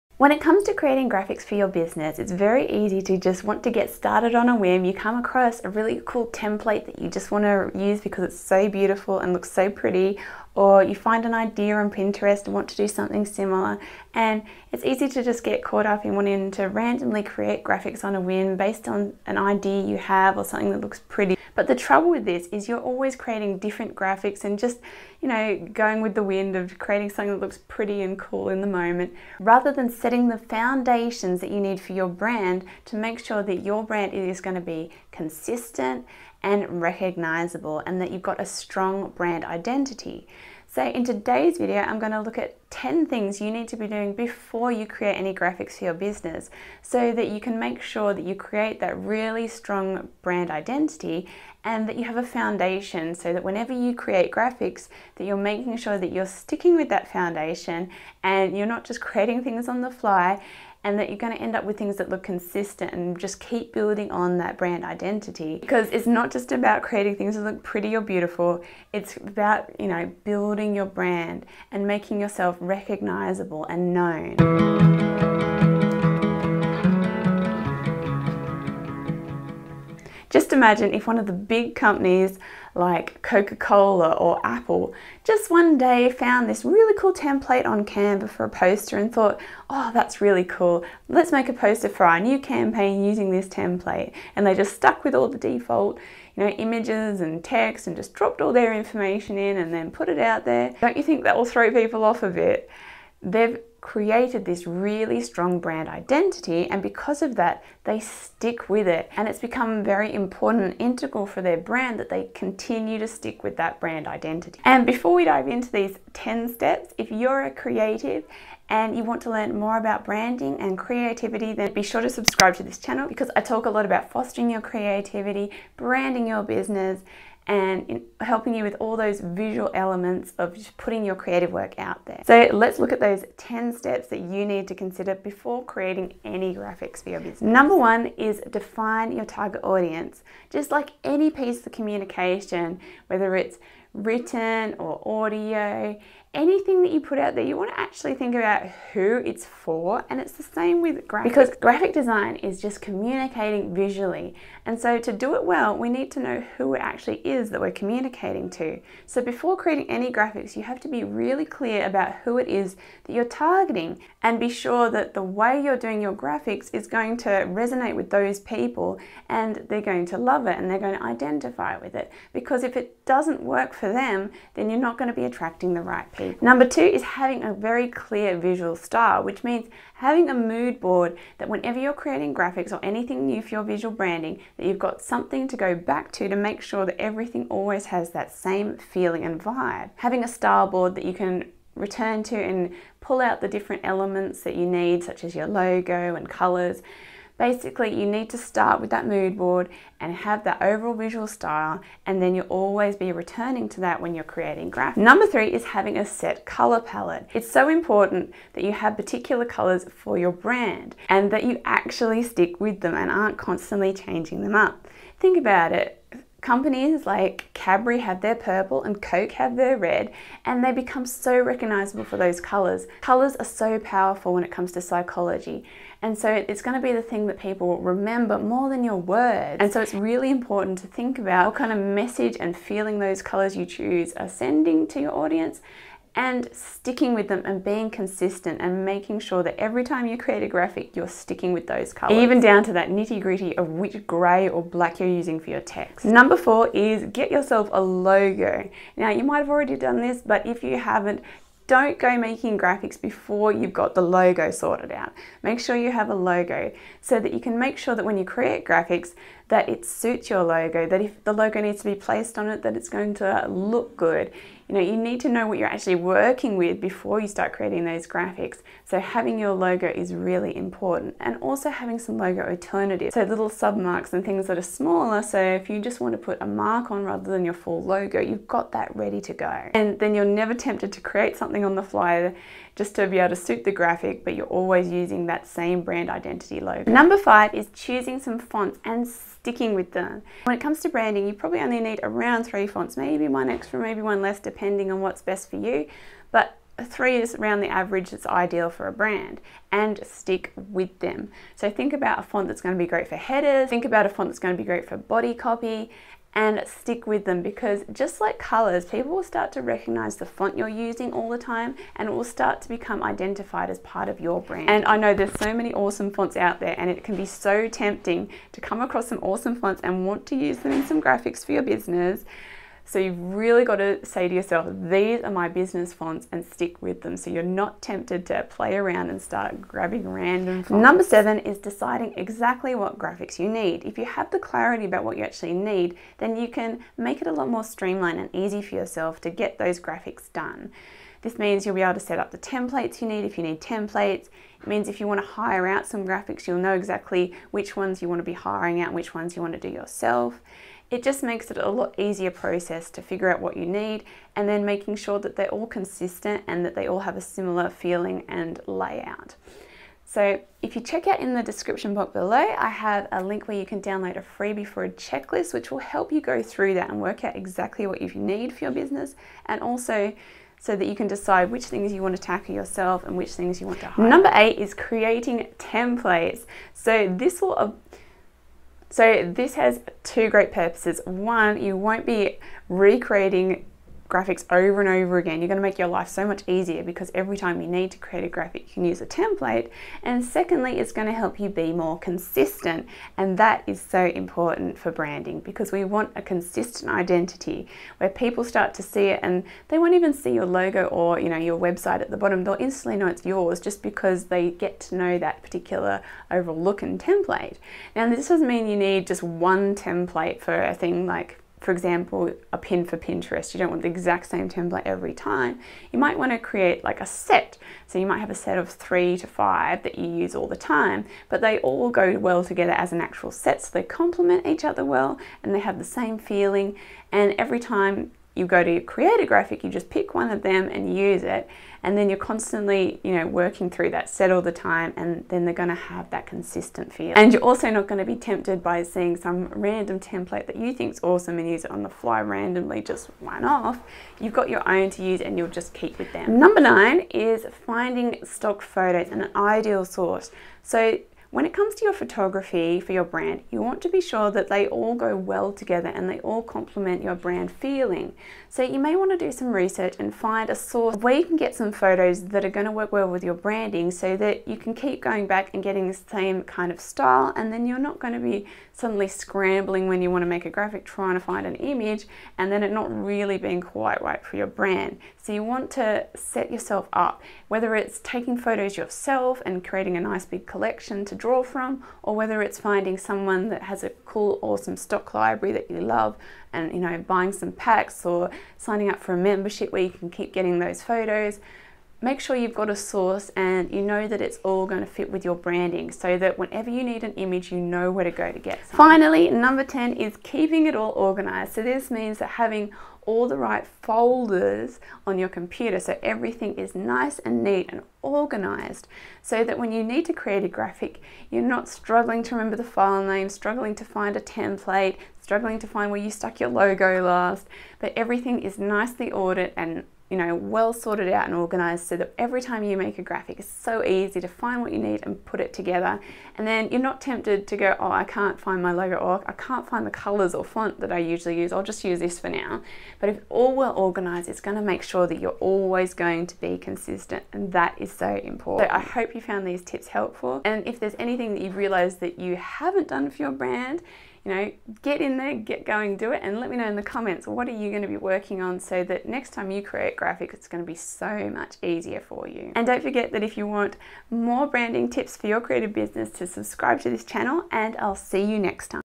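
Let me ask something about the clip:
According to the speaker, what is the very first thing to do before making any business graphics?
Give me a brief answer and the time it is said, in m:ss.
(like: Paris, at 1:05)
Define your target audience, at 2:18.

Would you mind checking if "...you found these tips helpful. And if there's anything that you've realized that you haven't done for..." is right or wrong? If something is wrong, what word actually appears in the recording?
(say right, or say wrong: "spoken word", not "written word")
right.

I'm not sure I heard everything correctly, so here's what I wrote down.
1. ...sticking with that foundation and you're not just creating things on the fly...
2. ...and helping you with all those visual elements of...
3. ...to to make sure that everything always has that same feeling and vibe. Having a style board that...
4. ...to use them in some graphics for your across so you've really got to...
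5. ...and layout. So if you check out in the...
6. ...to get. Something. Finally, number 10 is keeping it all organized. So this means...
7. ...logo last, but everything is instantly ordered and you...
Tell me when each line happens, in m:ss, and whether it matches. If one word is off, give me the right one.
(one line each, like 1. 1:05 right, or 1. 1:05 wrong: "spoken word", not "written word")
1. 0:56 right
2. 2:07 right
3. 3:06 right
4. 5:20 wrong: "business", not "across"
5. 5:58 right
6. 8:18 right
7. 8:36 wrong: "nicely", not "instantly".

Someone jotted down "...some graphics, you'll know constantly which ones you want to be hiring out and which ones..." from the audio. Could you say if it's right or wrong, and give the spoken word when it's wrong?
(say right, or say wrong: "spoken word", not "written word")
wrong: "exactly", not "constantly".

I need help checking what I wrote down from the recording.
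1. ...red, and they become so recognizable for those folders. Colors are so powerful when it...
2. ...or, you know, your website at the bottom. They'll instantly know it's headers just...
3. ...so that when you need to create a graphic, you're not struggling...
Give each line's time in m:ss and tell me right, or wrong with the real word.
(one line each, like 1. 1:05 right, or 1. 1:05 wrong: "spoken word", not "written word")
1. 3:39 wrong: "colors", not "folders"
2. 6:40 wrong: "yours", not "headers"
3. 8:29 right.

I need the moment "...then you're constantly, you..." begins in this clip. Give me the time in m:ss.
7:11.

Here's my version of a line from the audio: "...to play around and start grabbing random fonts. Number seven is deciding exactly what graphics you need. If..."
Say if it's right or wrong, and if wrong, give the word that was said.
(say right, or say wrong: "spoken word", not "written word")
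right.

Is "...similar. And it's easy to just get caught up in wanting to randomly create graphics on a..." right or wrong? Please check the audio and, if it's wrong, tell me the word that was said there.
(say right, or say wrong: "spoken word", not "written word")
right.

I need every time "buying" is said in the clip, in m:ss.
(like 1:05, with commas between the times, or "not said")
8:06.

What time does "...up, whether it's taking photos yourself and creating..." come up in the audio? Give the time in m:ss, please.
7:56.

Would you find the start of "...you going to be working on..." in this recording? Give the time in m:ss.
9:07.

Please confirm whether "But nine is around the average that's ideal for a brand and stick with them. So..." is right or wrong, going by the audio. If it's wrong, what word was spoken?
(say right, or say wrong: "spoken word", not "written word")
wrong: "three", not "nine".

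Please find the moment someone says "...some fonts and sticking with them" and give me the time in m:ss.
4:48.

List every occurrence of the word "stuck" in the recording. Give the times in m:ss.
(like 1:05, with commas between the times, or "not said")
1:34, 8:36.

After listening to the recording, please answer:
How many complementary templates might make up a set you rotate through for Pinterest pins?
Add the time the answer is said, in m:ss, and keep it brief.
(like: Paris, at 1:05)
3 to 5, at 6:58.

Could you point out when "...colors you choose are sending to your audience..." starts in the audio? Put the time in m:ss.
3:53.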